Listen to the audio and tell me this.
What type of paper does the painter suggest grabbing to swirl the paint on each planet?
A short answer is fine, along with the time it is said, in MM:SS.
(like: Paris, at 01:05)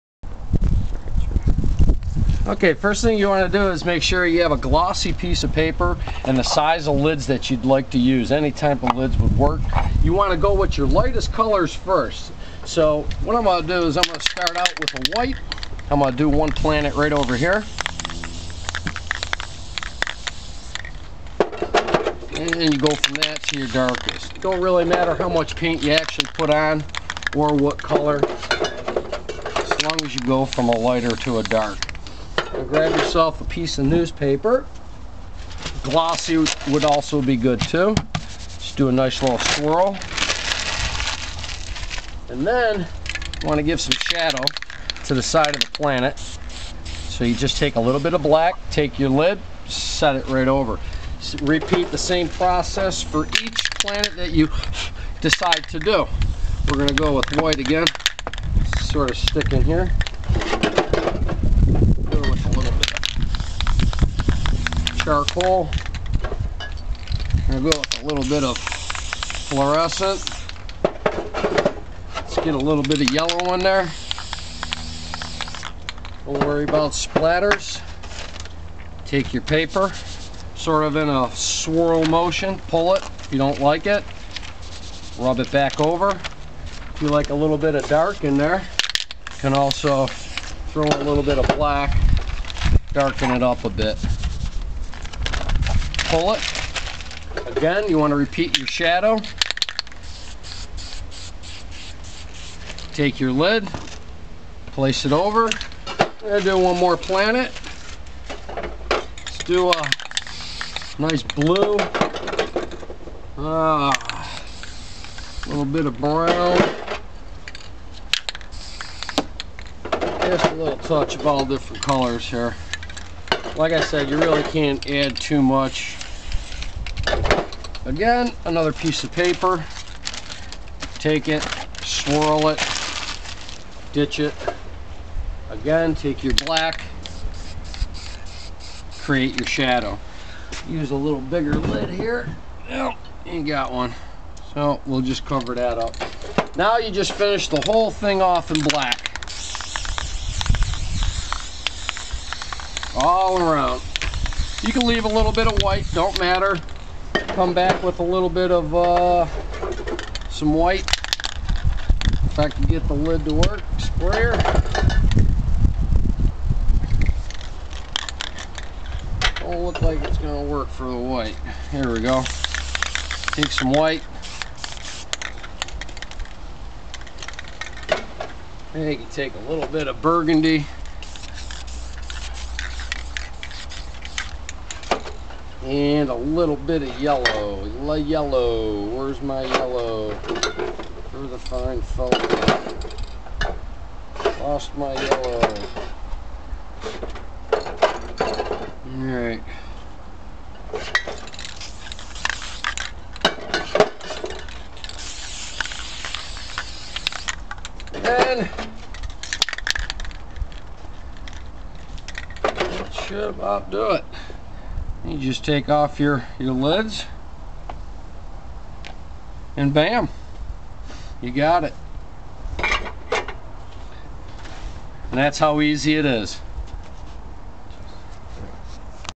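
Newspaper, at 00:33.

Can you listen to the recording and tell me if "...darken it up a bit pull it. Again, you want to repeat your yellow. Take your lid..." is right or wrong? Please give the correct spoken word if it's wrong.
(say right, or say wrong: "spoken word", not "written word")
wrong: "shadow", not "yellow".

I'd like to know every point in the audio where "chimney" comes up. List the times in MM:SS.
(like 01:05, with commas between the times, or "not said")
not said.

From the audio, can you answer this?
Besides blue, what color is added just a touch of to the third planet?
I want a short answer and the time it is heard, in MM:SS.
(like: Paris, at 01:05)
Brown, at 01:55.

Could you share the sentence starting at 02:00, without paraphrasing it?
Just a little touch of all different colors here.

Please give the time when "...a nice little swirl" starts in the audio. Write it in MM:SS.
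00:38.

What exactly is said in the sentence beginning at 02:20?
Use a little bigger lid here.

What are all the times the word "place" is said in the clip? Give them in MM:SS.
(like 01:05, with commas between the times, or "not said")
01:44.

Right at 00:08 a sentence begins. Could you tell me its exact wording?
Any type of lids would work.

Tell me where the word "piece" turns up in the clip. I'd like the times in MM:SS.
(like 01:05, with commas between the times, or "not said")
00:05, 00:33, 02:08.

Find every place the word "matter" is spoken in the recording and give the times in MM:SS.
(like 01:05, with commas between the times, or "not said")
00:24, 02:36.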